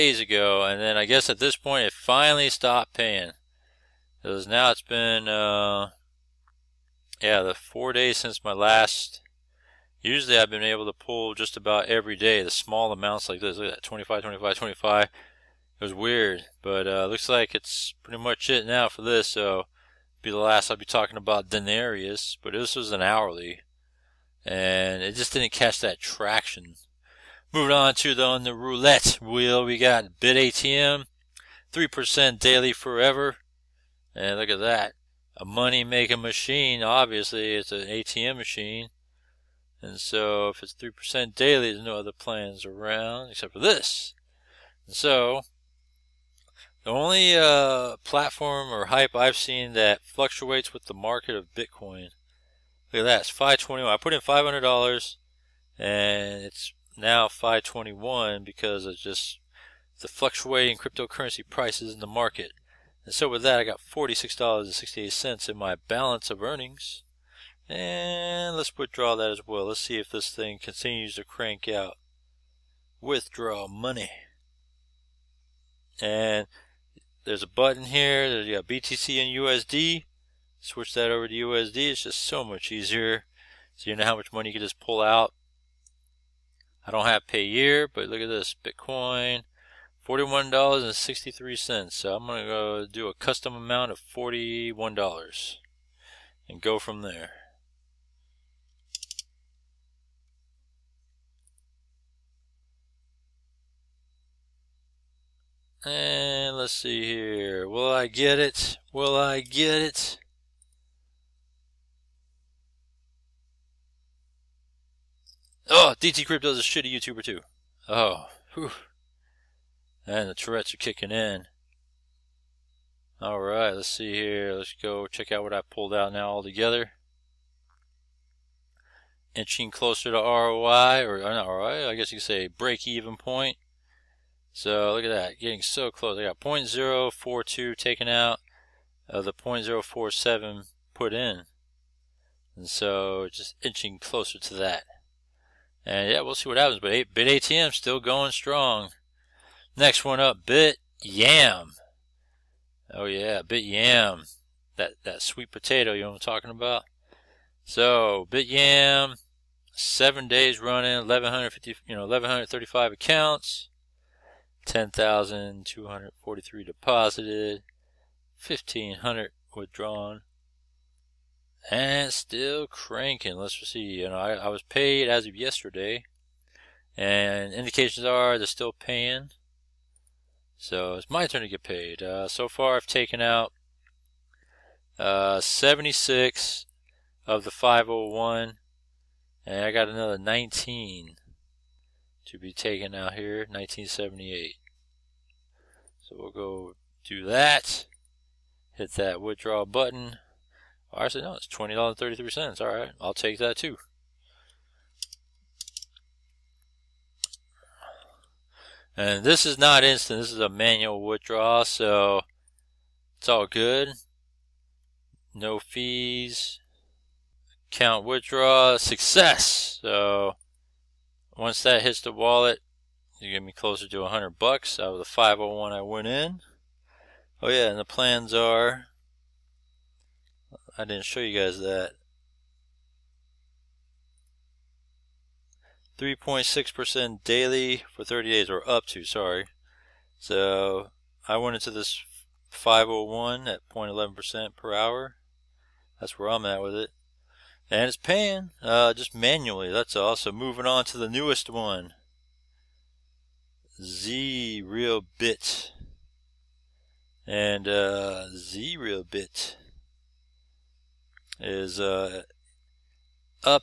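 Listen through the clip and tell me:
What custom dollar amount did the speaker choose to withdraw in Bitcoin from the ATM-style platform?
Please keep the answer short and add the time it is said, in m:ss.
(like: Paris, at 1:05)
$41, at 1:33.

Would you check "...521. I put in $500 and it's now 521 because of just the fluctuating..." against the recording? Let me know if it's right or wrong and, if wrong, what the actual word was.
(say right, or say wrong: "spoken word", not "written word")
right.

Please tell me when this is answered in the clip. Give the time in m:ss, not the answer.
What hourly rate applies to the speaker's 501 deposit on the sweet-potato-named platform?
4:03.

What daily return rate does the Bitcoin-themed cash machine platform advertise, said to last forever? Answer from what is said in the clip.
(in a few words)
3%.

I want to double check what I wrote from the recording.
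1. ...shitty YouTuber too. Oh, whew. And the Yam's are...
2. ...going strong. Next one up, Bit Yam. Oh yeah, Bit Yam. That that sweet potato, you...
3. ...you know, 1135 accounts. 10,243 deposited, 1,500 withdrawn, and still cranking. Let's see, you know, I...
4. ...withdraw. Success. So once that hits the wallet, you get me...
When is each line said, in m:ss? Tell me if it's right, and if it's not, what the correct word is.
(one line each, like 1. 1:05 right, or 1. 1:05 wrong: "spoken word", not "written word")
1. 1:56 wrong: "Tourette", not "Yam"
2. 2:27 right
3. 2:41 right
4. 3:38 right.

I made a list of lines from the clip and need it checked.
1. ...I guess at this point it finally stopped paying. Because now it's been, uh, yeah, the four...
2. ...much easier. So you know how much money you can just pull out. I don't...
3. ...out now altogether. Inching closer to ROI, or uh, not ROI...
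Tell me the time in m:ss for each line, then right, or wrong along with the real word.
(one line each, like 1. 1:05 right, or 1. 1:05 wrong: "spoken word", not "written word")
1. 0:00 right
2. 1:22 right
3. 2:05 right.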